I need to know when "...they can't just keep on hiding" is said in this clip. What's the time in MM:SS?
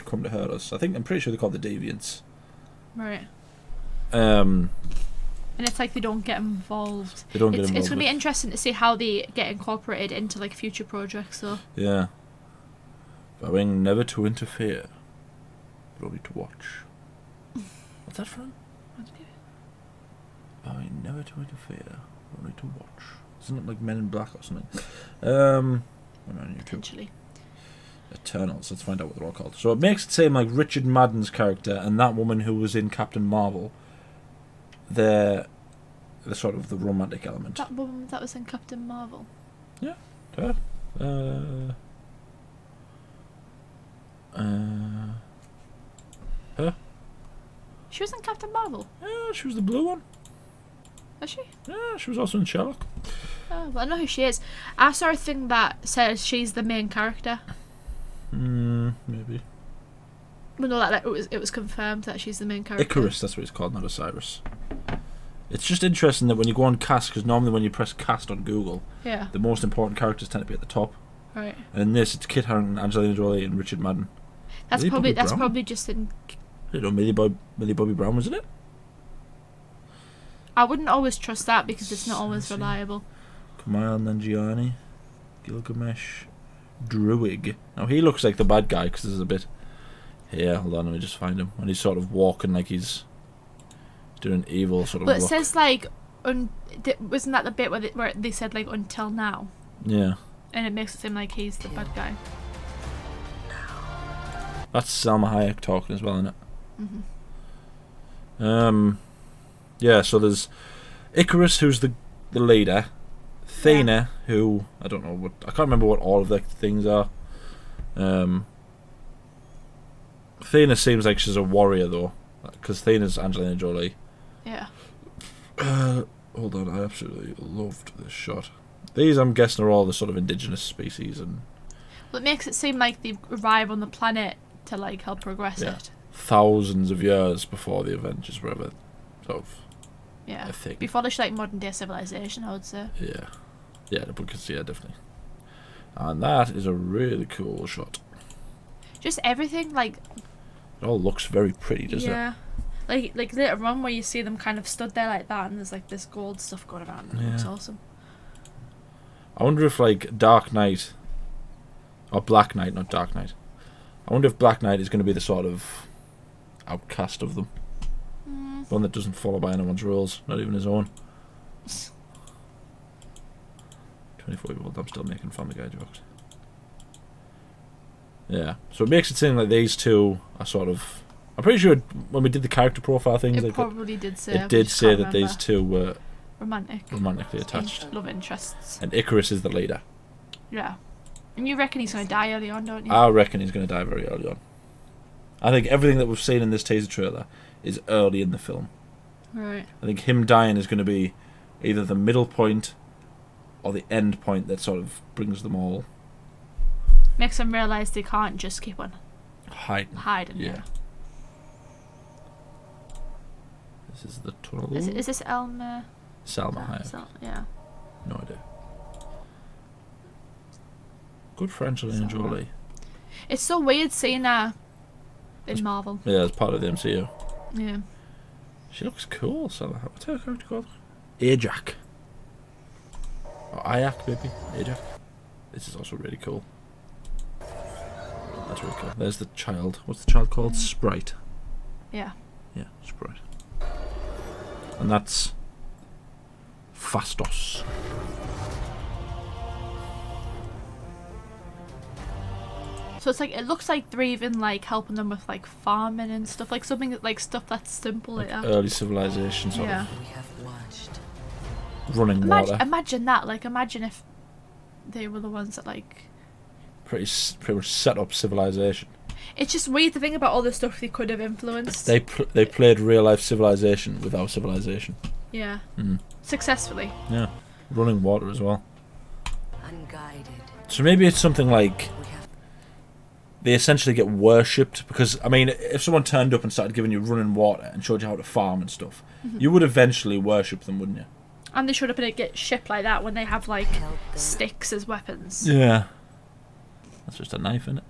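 03:27.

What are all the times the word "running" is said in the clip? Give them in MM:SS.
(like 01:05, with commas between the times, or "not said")
04:21, 04:37, 04:46.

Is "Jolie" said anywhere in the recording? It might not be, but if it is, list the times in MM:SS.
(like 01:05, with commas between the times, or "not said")
01:13, 02:03, 03:42.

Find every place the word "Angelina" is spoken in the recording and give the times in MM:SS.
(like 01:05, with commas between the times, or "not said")
01:12, 02:03, 03:41.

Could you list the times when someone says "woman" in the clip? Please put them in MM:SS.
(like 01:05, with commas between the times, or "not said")
00:32, 00:37.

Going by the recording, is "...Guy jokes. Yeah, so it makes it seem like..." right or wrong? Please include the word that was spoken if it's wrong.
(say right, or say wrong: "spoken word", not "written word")
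right.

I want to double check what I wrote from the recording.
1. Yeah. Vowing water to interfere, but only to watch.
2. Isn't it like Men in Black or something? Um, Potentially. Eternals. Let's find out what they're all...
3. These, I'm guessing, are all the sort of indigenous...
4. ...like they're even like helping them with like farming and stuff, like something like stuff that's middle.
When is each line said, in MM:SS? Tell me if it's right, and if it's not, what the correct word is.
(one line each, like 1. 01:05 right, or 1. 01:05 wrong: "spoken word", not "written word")
1. 00:11 wrong: "never", not "water"
2. 00:23 right
3. 02:08 right
4. 04:13 wrong: "simple", not "middle".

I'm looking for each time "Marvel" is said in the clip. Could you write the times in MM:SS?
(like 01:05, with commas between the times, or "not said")
00:33, 00:38, 00:48, 03:45.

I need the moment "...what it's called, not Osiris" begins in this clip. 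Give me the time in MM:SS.
01:03.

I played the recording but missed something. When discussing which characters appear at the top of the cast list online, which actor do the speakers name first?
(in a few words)
Kit Harington.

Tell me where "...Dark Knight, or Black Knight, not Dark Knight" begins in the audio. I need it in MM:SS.
02:40.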